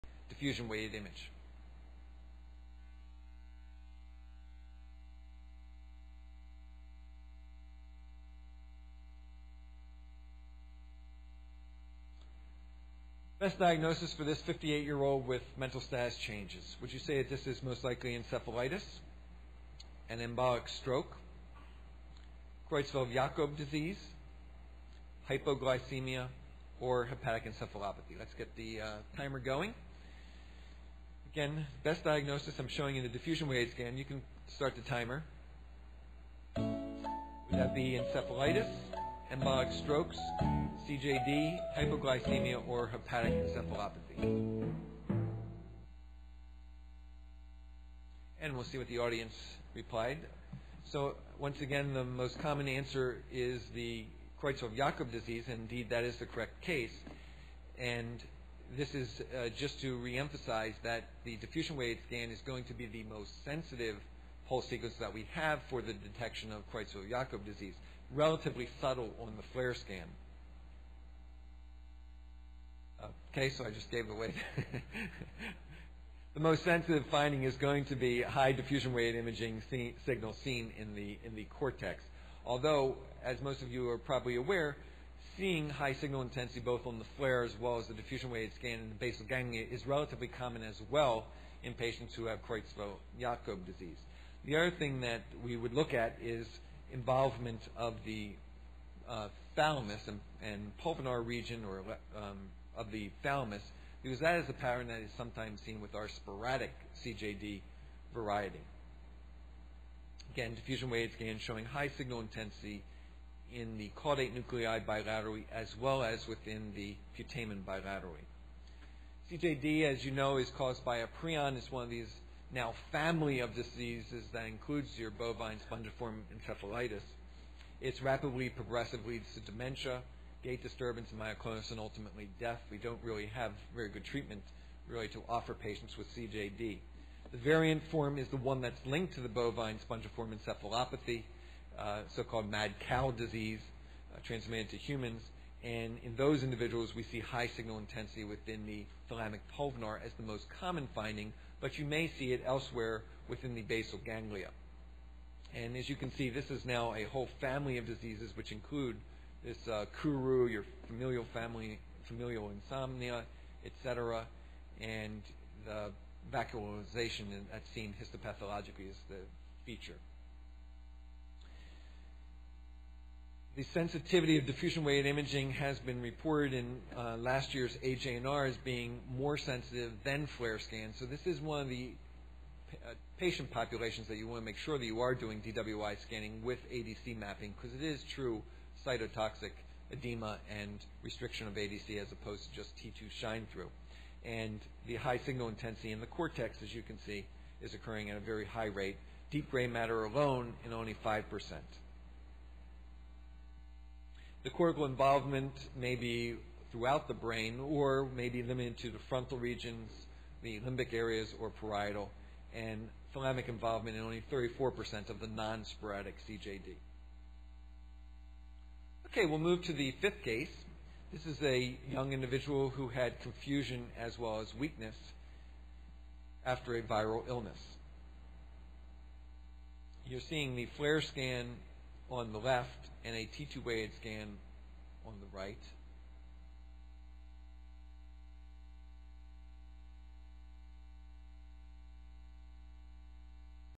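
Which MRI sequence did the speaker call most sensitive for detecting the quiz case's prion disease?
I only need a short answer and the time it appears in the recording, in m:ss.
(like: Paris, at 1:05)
Diffusion weighted scan, at 1:01.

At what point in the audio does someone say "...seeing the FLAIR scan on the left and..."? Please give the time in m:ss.
3:50.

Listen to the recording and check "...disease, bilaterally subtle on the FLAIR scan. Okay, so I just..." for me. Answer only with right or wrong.
wrong.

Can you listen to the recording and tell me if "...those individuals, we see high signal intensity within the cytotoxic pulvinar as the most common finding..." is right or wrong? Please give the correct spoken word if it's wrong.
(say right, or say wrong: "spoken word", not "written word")
wrong: "thalamic", not "cytotoxic".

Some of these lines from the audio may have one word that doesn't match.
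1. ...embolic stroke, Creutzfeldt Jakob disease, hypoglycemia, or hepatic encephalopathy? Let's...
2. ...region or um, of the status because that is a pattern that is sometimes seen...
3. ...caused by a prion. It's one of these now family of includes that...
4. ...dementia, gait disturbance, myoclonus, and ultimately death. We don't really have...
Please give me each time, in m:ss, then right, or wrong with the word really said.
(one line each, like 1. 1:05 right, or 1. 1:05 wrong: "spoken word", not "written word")
1. 0:20 right
2. 1:41 wrong: "thalamus", not "status"
3. 2:00 wrong: "diseases", not "includes"
4. 2:09 right.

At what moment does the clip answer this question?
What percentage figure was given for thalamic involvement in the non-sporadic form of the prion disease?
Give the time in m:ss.
3:34.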